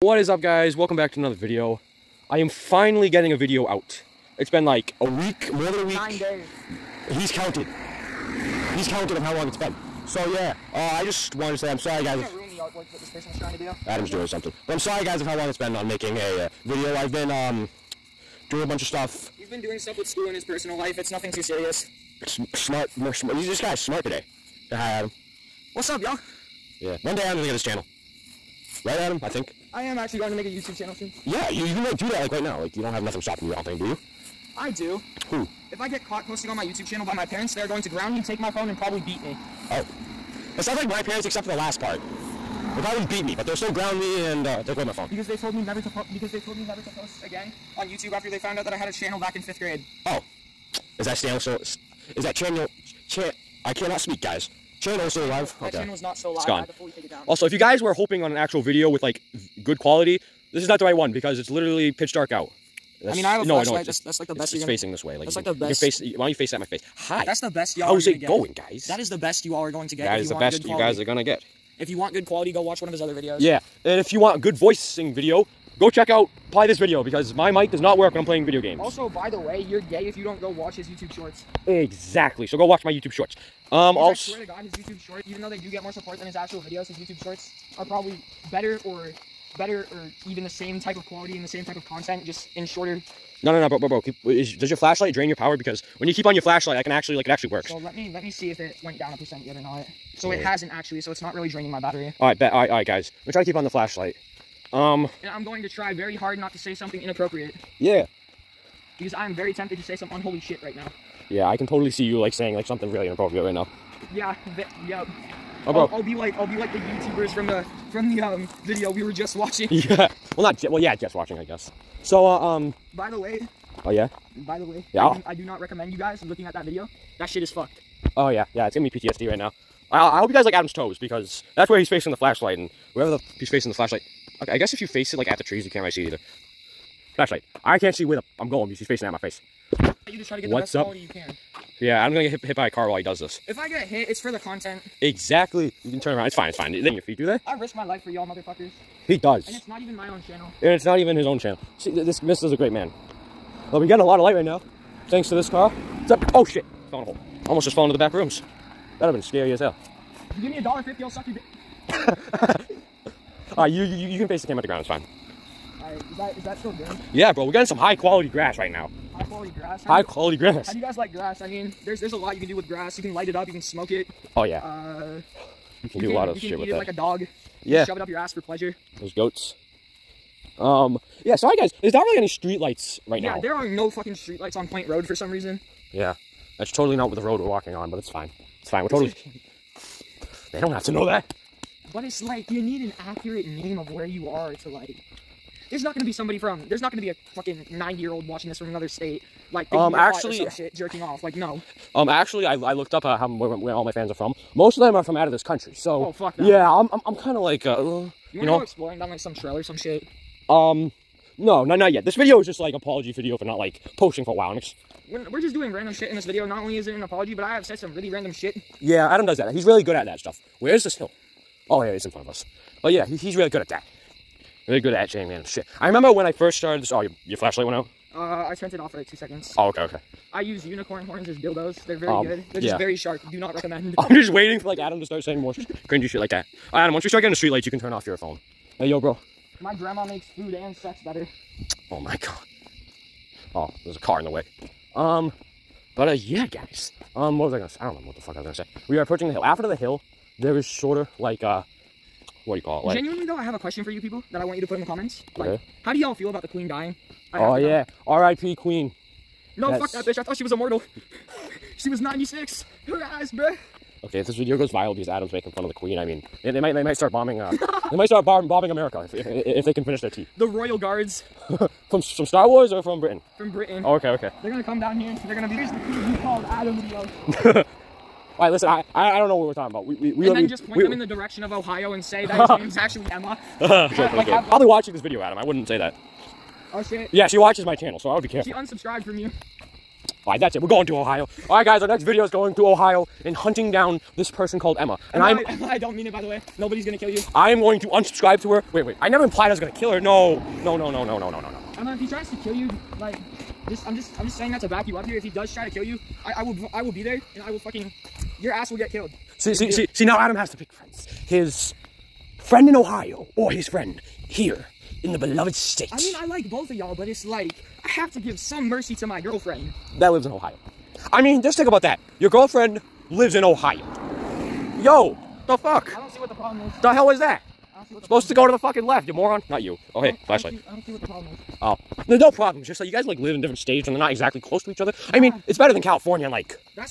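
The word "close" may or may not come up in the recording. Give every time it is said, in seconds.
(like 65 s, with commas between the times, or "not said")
334 s.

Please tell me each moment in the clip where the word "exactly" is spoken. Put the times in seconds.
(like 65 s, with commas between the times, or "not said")
81 s, 145 s, 334 s.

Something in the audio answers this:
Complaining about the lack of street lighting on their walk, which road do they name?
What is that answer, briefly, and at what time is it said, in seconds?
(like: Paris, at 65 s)
Point Road, at 184 s.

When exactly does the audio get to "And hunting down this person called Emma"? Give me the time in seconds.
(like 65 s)
293 s.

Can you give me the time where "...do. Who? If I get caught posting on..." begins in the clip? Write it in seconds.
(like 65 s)
34 s.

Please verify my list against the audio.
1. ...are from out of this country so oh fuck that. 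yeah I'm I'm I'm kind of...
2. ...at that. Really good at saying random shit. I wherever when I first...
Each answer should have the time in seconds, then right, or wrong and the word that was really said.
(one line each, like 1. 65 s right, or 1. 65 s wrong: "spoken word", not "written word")
1. 204 s right
2. 223 s wrong: "remember", not "wherever".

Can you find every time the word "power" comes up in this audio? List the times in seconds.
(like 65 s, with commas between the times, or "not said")
95 s.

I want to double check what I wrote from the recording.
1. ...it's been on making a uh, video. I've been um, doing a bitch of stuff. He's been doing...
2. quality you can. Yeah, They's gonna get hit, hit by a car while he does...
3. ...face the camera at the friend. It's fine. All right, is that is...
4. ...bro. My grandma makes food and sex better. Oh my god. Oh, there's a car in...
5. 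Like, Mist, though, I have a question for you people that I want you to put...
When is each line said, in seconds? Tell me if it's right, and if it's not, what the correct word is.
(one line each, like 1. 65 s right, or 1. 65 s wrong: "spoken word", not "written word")
1. 15 s wrong: "bunch", not "bitch"
2. 140 s wrong: "Adam", not "They"
3. 164 s wrong: "ground", not "friend"
4. 238 s right
5. 252 s wrong: "Genuinely", not "Mist".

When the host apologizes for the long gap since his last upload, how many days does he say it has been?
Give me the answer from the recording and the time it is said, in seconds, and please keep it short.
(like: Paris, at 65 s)
9 days, at 5 s.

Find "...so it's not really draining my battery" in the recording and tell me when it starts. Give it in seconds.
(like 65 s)
101 s.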